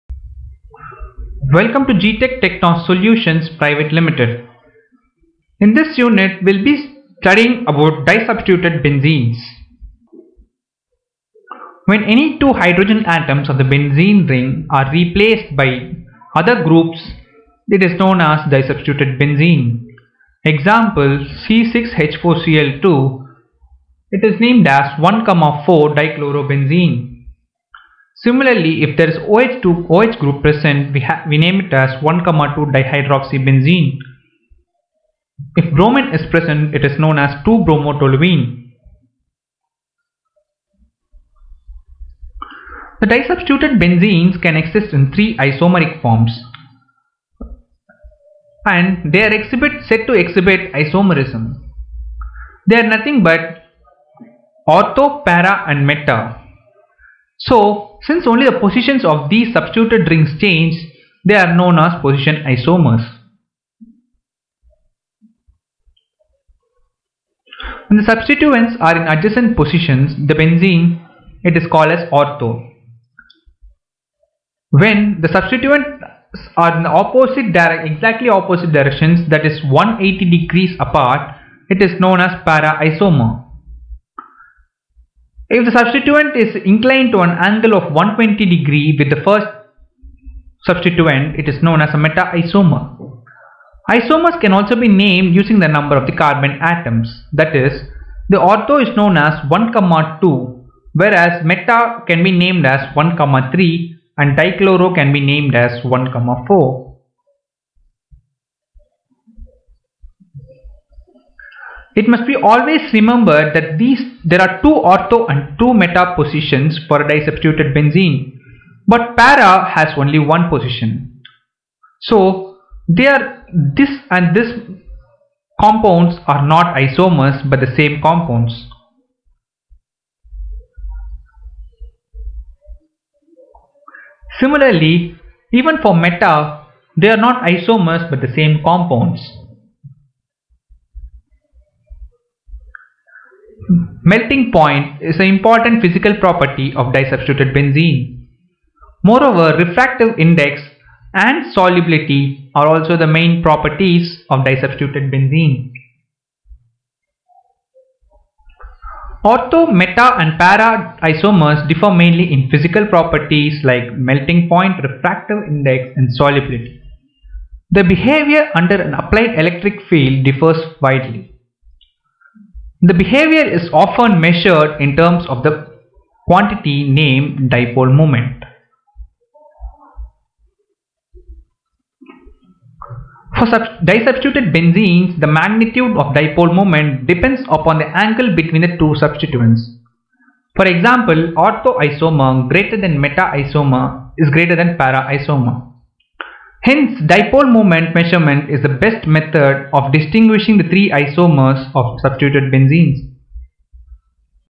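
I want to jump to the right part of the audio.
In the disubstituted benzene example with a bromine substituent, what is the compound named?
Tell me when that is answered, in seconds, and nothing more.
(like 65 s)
37 s.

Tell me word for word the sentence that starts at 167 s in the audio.
The behavior under an applied electric field differs widely.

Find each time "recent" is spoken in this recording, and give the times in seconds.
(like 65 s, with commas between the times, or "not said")
not said.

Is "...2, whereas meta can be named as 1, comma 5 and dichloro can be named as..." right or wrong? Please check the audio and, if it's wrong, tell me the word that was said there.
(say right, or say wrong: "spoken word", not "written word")
wrong: "3", not "5".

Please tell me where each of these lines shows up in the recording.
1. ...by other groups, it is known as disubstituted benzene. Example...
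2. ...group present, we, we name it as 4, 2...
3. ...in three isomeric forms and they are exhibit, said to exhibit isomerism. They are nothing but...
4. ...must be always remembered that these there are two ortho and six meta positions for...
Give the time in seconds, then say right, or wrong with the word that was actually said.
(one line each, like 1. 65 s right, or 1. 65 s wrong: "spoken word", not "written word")
1. 15 s right
2. 30 s wrong: "1", not "4"
3. 44 s right
4. 112 s wrong: "two", not "six".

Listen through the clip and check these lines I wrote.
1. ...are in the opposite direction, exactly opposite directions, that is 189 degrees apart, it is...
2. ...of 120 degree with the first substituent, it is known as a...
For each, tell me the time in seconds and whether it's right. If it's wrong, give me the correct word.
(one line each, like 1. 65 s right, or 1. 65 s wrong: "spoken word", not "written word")
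1. 76 s wrong: "180", not "189"
2. 87 s right.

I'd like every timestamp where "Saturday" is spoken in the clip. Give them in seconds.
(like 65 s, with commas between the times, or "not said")
not said.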